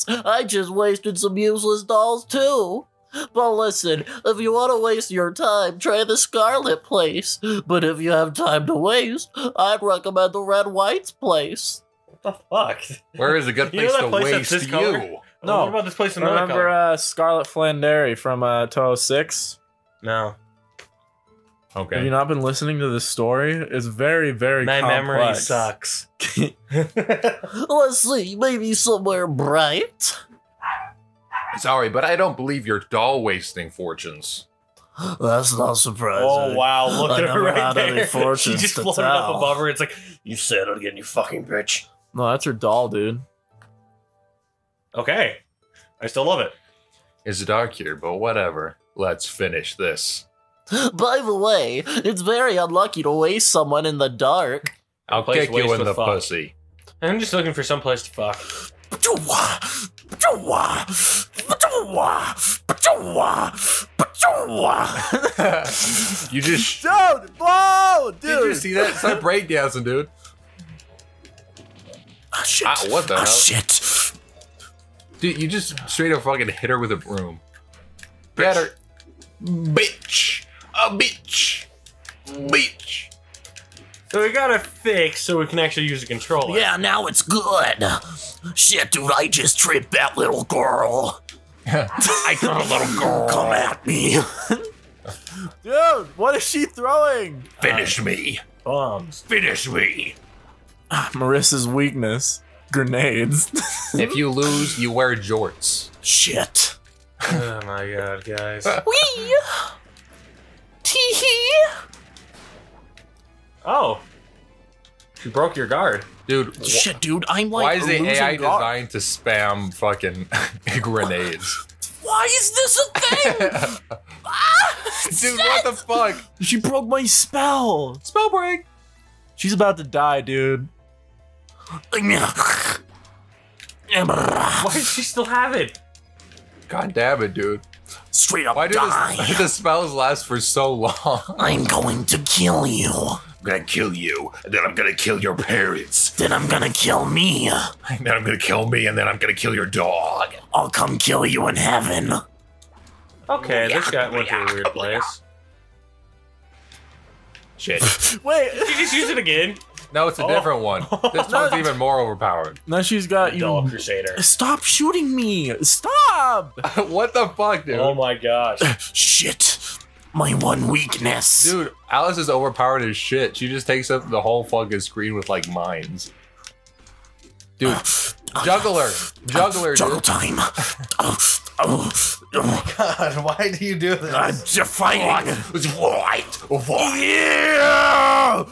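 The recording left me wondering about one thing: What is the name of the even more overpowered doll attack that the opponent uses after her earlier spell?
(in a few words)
Doll Crusader.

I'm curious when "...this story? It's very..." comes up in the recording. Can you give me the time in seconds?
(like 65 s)
22 s.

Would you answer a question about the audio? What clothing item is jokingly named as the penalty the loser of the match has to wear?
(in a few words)
Jorts.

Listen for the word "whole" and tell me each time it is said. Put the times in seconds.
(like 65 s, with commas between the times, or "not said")
174 s.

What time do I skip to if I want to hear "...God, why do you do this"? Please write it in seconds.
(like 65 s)
182 s.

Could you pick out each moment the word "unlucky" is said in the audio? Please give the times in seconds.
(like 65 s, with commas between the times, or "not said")
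52 s.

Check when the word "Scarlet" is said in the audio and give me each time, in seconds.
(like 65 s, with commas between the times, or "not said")
6 s, 16 s.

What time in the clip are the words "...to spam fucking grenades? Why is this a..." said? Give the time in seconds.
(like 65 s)
118 s.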